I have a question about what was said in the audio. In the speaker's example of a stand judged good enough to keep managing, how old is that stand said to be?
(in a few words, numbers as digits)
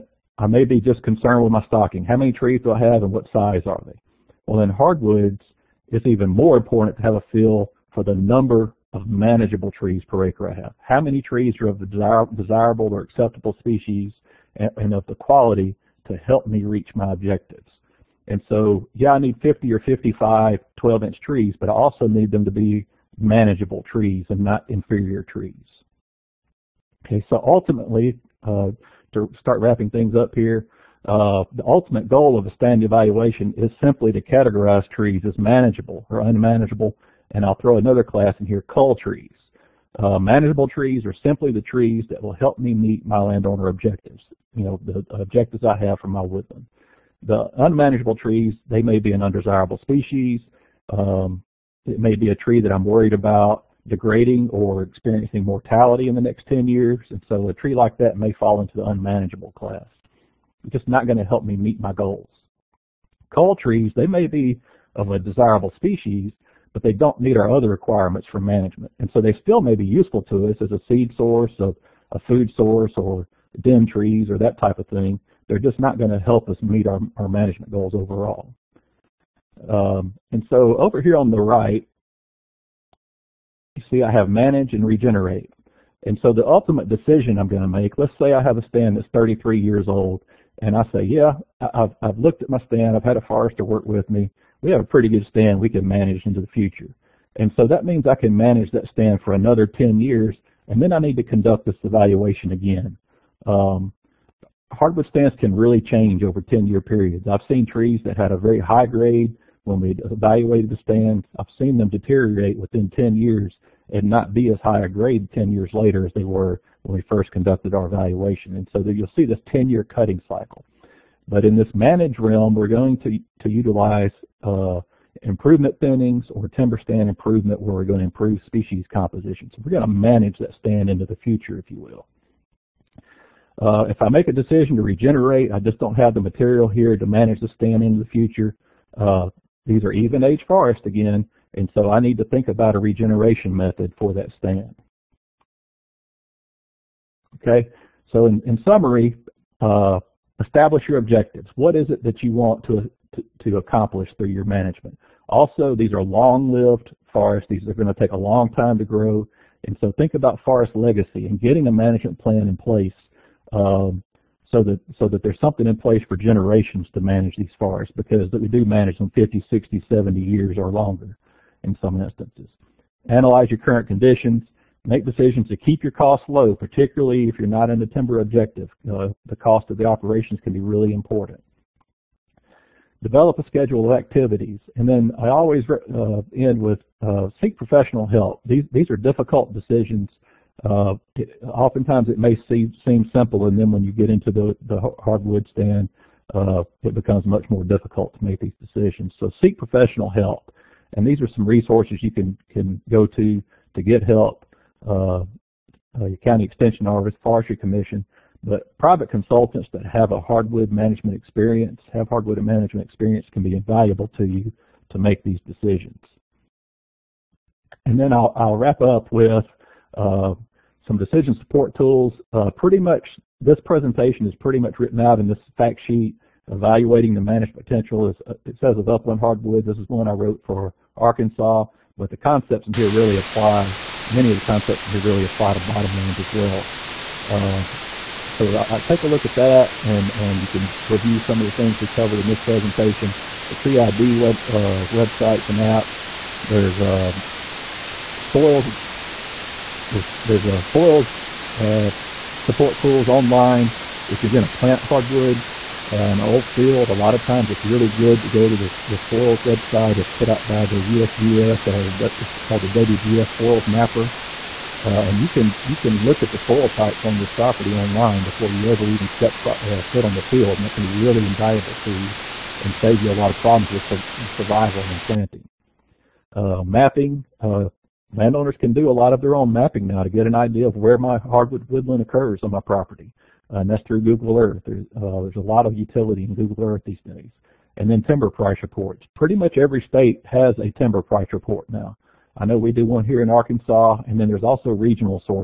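33 years.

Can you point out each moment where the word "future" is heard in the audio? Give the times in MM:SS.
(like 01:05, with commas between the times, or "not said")
01:36, 02:11, 02:18.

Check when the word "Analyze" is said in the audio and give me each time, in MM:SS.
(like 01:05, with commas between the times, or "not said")
02:53.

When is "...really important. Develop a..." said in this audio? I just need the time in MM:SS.
03:00.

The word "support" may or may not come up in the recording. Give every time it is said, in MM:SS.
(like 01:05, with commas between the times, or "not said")
03:41, 04:12.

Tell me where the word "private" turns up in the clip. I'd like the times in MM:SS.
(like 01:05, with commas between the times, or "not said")
03:28.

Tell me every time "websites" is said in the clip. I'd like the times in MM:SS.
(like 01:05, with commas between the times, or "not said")
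04:04, 04:19.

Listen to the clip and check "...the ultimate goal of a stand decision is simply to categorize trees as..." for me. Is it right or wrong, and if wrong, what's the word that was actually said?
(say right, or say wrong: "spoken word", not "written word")
wrong: "evaluation", not "decision".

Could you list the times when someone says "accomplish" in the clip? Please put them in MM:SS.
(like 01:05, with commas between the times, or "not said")
02:33.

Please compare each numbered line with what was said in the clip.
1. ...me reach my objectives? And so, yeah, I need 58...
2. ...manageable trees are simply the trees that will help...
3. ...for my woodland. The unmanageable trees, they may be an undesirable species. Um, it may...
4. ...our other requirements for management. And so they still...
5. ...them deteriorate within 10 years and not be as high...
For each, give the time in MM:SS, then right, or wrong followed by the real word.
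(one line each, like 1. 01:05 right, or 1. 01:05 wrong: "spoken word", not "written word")
1. 00:16 wrong: "50", not "58"
2. 00:40 right
3. 00:45 right
4. 01:07 right
5. 01:51 right.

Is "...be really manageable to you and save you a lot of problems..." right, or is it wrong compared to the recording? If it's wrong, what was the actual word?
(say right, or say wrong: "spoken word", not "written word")
wrong: "invaluable", not "manageable".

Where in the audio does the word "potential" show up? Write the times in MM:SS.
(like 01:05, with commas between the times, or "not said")
03:47.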